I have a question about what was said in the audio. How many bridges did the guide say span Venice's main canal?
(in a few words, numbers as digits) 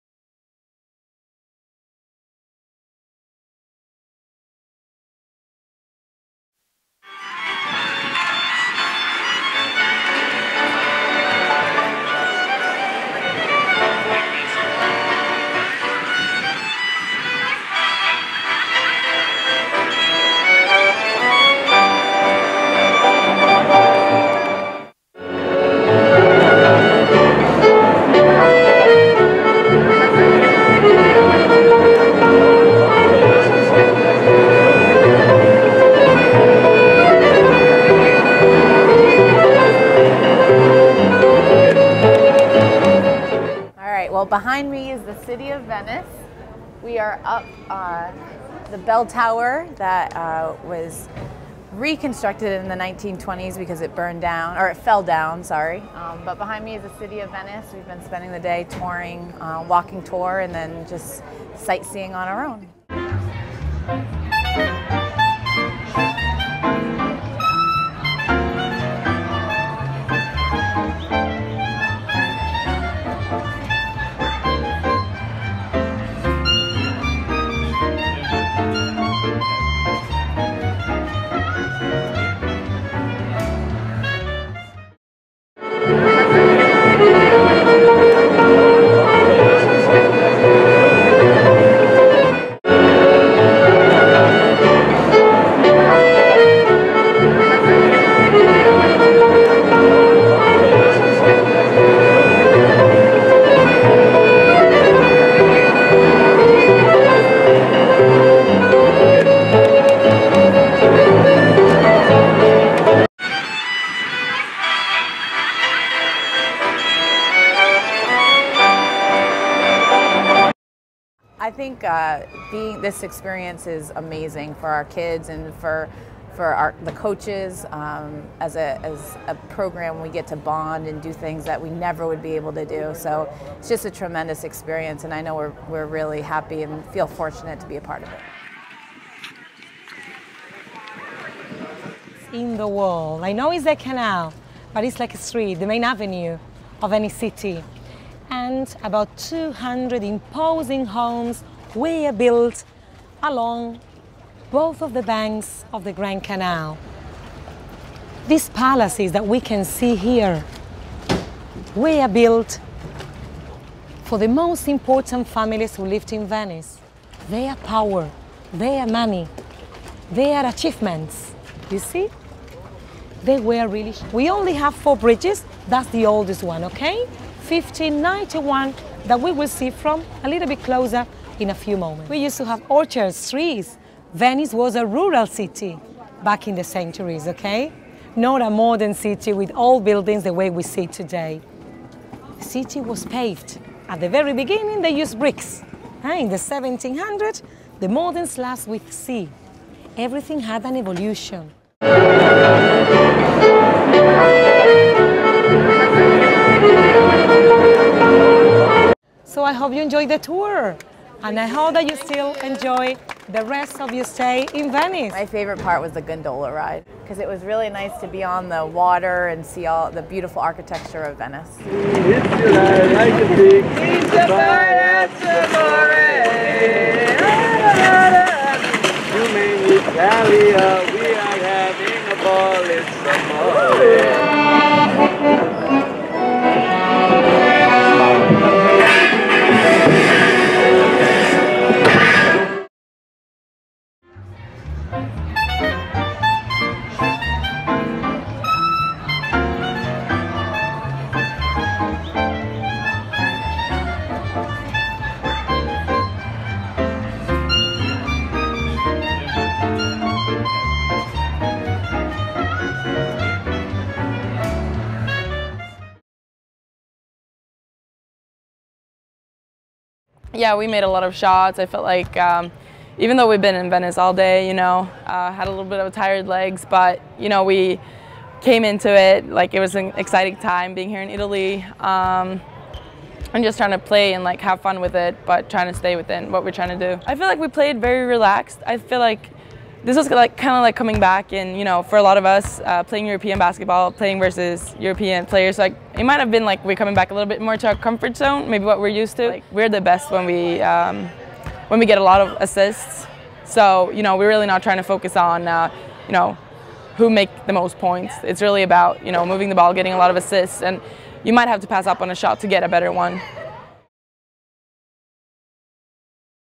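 4.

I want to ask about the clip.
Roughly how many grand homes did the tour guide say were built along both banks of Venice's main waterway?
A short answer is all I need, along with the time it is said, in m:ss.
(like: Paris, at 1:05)
200, at 2:29.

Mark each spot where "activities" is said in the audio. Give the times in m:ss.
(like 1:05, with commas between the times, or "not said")
not said.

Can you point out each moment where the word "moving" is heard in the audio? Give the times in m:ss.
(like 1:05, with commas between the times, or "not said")
5:09.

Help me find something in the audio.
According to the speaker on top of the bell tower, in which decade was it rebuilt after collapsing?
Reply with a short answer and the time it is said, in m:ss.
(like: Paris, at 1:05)
1920s, at 0:52.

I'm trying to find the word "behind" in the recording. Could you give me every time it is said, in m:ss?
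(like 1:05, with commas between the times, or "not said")
0:44, 0:56.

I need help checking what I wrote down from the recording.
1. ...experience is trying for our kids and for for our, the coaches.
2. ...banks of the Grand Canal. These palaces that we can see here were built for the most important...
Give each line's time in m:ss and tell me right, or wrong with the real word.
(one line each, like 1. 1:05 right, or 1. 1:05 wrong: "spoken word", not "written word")
1. 2:03 wrong: "amazing", not "trying"
2. 2:35 right.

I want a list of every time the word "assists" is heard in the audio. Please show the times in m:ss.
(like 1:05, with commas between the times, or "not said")
5:02, 5:10.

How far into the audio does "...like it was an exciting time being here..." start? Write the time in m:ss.
4:39.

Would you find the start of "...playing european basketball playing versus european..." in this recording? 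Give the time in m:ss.
4:52.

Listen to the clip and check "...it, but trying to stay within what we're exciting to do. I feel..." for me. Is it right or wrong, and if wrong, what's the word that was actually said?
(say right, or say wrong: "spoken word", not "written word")
wrong: "trying", not "exciting".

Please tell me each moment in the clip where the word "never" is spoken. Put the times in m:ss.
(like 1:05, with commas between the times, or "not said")
2:11.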